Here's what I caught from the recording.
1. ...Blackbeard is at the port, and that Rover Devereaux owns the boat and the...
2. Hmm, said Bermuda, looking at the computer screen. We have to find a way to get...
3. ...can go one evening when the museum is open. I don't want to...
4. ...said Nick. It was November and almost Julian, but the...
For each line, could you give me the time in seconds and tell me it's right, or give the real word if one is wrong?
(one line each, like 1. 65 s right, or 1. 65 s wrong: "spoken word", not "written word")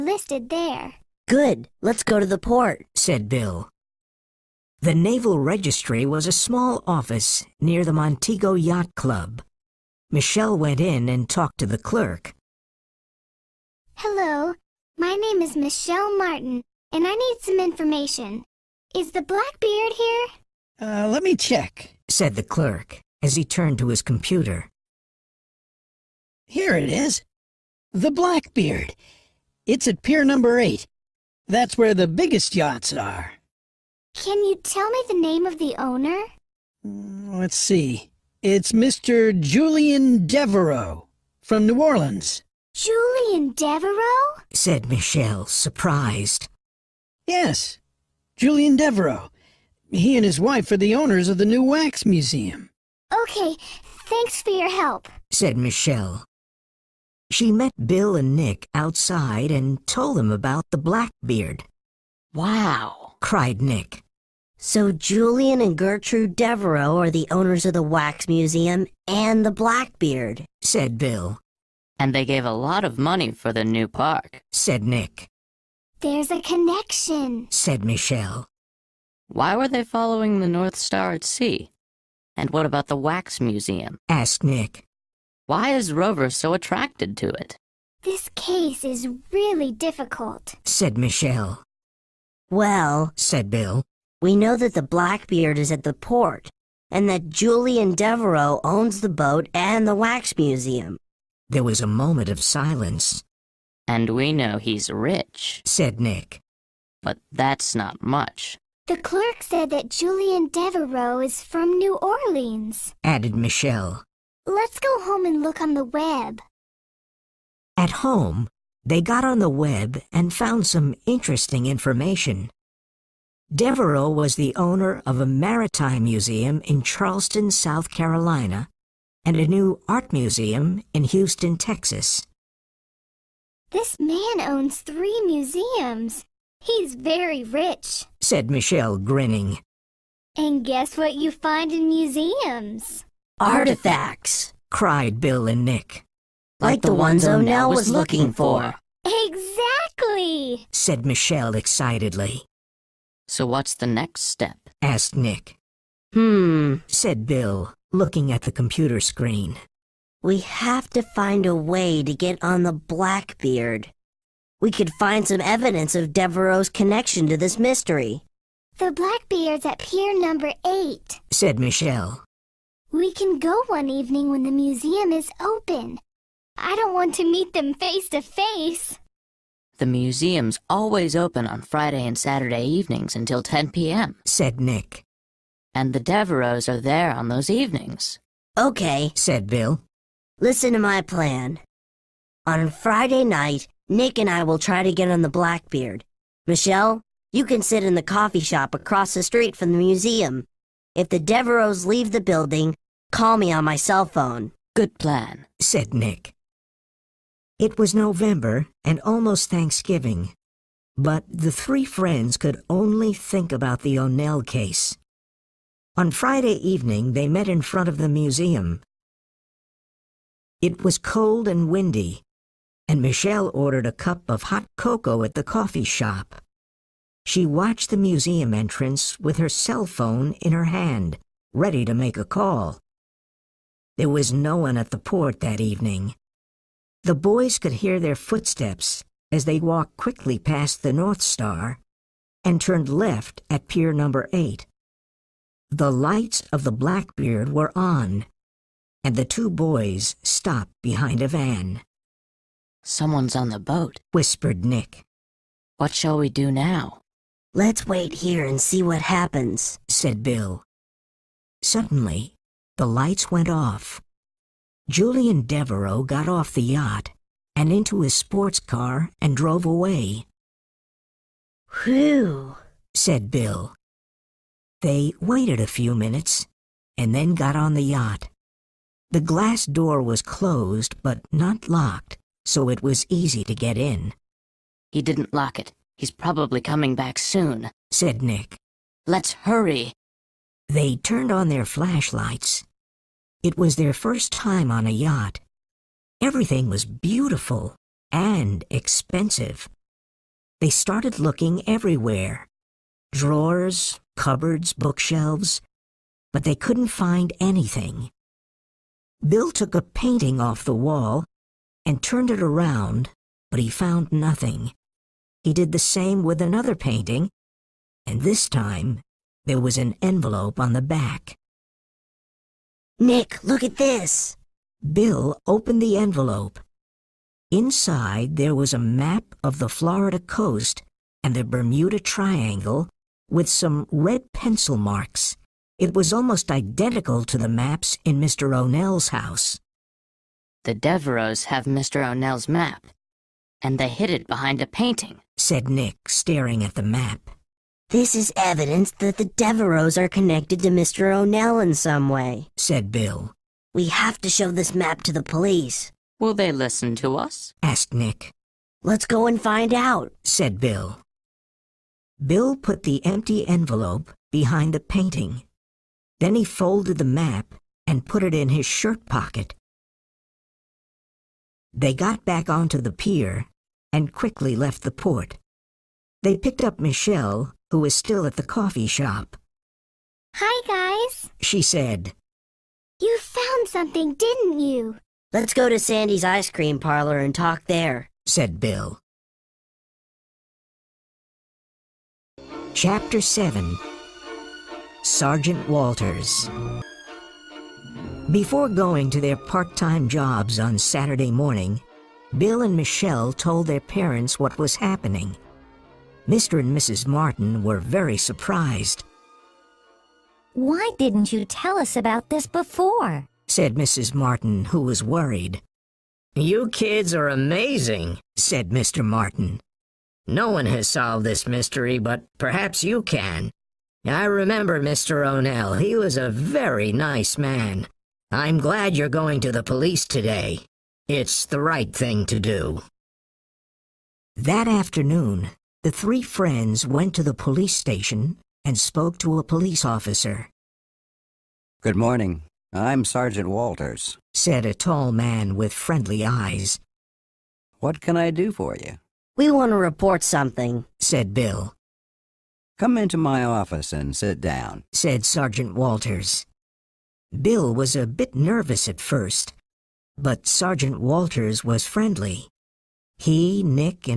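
1. 94 s wrong: "Julian", not "Rover"
2. 156 s wrong: "Bill", not "Bermuda"
3. 173 s right
4. 205 s wrong: "Thanksgiving", not "Julian".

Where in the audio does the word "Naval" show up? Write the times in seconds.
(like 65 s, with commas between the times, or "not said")
4 s.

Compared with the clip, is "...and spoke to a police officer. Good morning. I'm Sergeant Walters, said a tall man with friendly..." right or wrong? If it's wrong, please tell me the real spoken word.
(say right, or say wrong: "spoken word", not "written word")
right.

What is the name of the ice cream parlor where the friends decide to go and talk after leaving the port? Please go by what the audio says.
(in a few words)
Sandy's.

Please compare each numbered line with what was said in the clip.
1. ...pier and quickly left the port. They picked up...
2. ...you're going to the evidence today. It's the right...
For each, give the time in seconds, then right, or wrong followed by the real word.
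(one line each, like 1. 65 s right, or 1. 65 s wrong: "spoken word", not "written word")
1. 372 s right
2. 428 s wrong: "police", not "evidence".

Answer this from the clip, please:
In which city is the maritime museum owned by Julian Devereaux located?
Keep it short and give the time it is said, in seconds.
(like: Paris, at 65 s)
Charleston, at 126 s.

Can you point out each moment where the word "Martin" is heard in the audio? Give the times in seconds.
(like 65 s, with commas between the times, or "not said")
16 s, 407 s, 414 s, 419 s.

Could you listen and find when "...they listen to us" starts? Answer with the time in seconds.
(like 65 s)
356 s.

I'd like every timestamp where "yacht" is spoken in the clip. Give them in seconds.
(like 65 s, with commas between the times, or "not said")
8 s, 32 s, 266 s, 277 s, 294 s.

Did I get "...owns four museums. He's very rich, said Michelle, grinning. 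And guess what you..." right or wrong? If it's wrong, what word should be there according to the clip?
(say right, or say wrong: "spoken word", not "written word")
wrong: "three", not "four".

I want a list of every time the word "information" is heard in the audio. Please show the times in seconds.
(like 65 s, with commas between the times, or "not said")
17 s, 121 s.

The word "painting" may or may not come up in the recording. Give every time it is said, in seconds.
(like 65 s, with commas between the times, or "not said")
309 s, 316 s, 344 s, 364 s.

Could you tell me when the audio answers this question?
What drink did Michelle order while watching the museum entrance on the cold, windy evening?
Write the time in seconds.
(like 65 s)
224 s.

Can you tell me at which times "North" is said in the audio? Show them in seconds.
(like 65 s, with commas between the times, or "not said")
80 s, 240 s.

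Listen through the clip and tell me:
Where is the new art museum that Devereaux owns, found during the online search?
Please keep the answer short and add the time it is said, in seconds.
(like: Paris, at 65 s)
Houston, Texas, at 131 s.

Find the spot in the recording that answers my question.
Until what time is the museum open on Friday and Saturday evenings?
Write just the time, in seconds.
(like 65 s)
183 s.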